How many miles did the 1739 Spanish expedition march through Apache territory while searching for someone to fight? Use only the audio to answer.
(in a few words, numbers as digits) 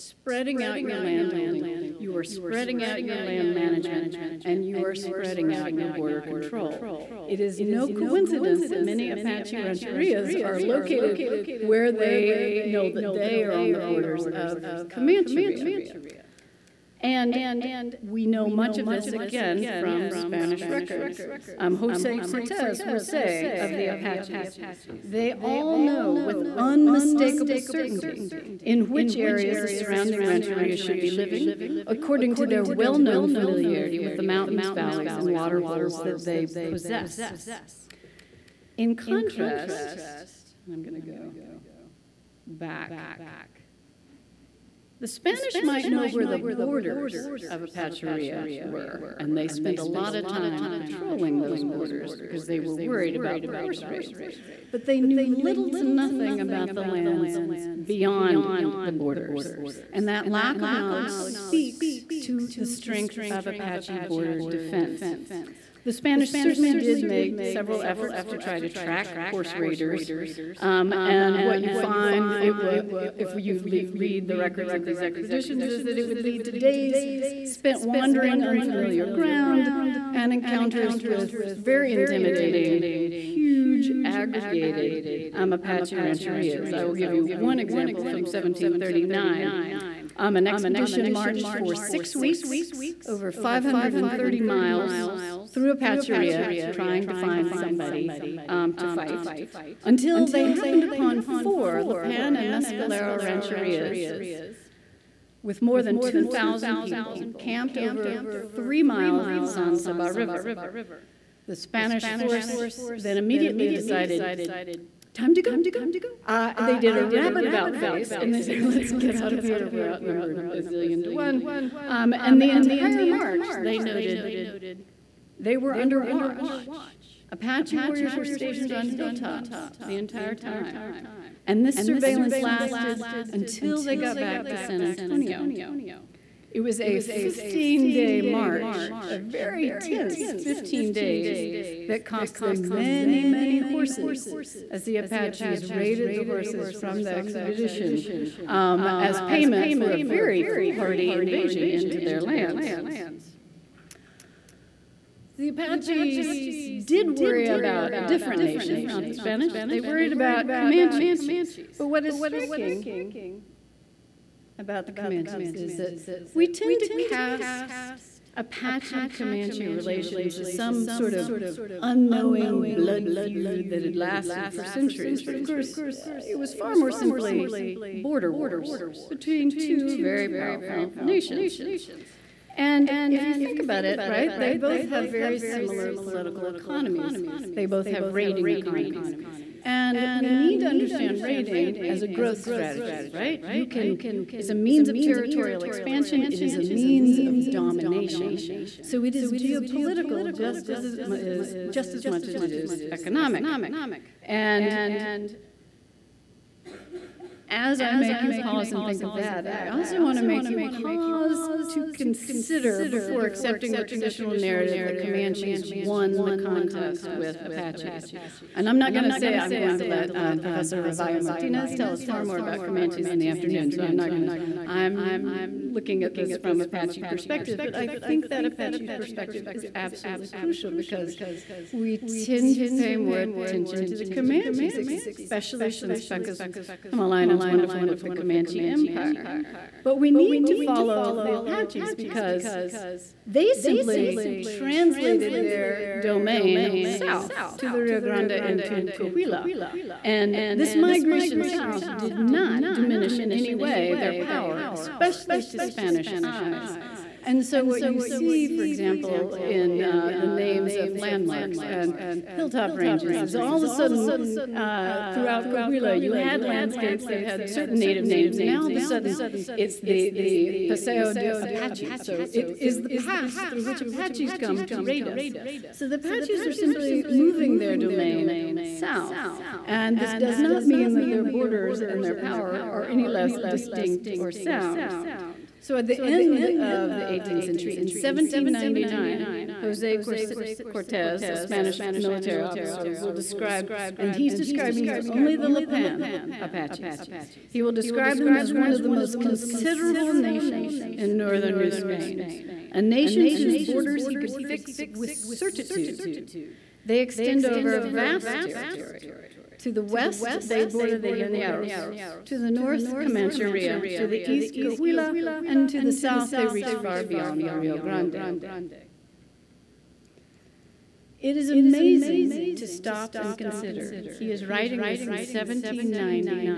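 530 miles.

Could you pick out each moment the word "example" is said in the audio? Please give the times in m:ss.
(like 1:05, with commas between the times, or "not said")
1:27, 4:18.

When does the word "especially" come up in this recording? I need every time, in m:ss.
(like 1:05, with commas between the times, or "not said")
3:54, 4:14.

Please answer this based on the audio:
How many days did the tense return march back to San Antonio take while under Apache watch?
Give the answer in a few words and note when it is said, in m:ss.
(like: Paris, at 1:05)
15 days, at 2:16.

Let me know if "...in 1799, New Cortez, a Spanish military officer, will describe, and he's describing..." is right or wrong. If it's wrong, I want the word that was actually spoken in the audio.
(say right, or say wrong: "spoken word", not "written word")
wrong: "Jose", not "New".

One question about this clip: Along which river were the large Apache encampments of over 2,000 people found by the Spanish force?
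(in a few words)
San Saba River.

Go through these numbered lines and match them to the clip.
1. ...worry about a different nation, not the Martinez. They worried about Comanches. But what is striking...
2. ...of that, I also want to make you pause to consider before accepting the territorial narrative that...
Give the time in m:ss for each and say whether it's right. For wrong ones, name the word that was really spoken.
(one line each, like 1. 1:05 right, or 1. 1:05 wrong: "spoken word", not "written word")
1. 2:37 wrong: "Spanish", not "Martinez"
2. 3:29 wrong: "traditional", not "territorial".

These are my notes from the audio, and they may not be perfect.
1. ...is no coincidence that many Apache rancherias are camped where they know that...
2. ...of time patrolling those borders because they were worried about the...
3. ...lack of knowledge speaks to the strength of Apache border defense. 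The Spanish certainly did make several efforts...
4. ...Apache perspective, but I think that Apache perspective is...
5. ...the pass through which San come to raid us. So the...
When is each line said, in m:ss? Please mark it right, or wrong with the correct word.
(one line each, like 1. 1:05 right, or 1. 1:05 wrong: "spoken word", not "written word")
1. 0:07 wrong: "located", not "camped"
2. 0:50 right
3. 1:00 right
4. 3:46 right
5. 4:32 wrong: "Apaches", not "San".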